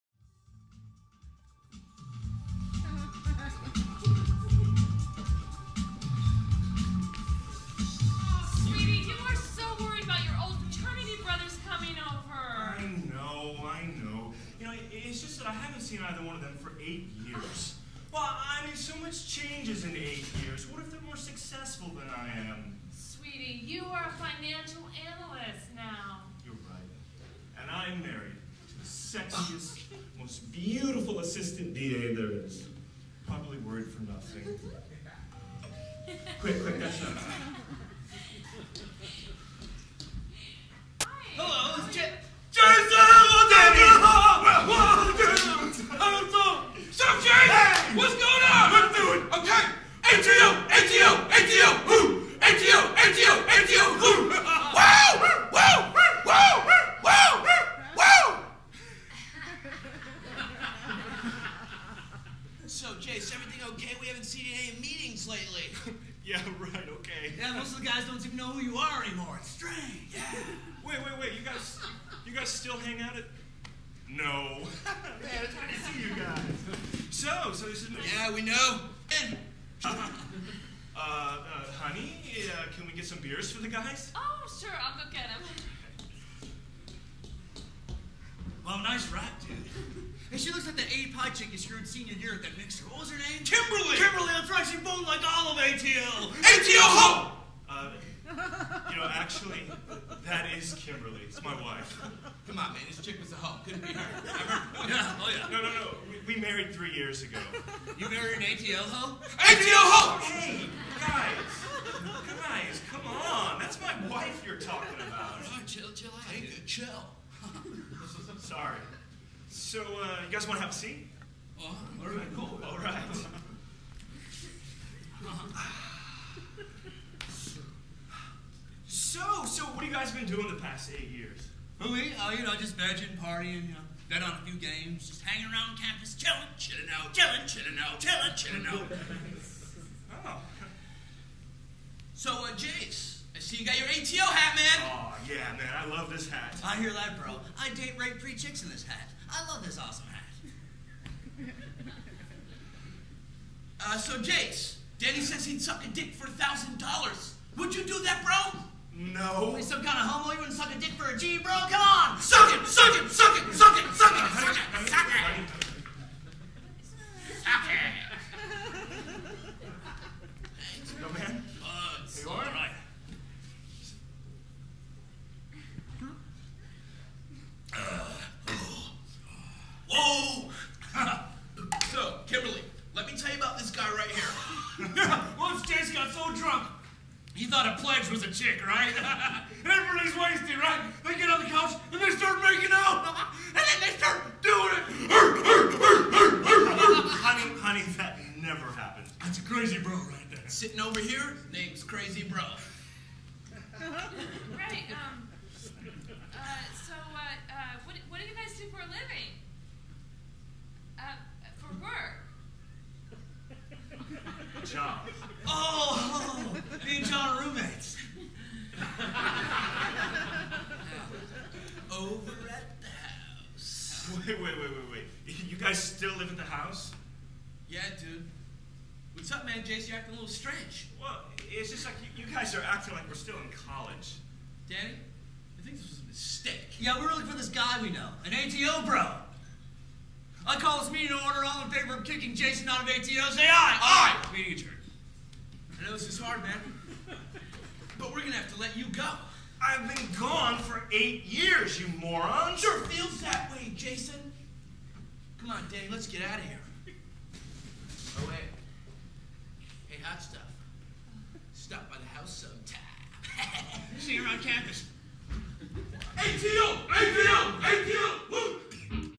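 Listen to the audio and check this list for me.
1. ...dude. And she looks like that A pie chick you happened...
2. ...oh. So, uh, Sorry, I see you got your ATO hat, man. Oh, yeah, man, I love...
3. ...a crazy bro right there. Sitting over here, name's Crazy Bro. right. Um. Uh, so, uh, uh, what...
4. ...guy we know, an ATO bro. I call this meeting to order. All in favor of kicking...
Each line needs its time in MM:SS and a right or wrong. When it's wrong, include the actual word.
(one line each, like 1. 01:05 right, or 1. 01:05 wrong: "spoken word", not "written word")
1. 01:29 wrong: "screwed", not "happened"
2. 02:20 wrong: "Jace", not "Sorry"
3. 03:19 right
4. 03:57 right.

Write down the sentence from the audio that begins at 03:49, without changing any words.
Jace, you're acting a little strange.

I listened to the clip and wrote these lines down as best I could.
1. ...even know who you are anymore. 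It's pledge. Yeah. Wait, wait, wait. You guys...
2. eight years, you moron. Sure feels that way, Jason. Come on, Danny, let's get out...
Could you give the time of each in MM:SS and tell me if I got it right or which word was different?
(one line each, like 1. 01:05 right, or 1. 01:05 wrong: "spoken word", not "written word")
1. 01:08 wrong: "strange", not "pledge"
2. 04:10 right.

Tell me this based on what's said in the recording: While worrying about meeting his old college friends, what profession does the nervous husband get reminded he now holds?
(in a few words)
Financial analyst.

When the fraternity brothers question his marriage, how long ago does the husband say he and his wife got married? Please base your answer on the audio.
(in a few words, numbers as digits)
3 years ago.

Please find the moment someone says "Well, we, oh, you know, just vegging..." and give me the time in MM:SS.
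02:11.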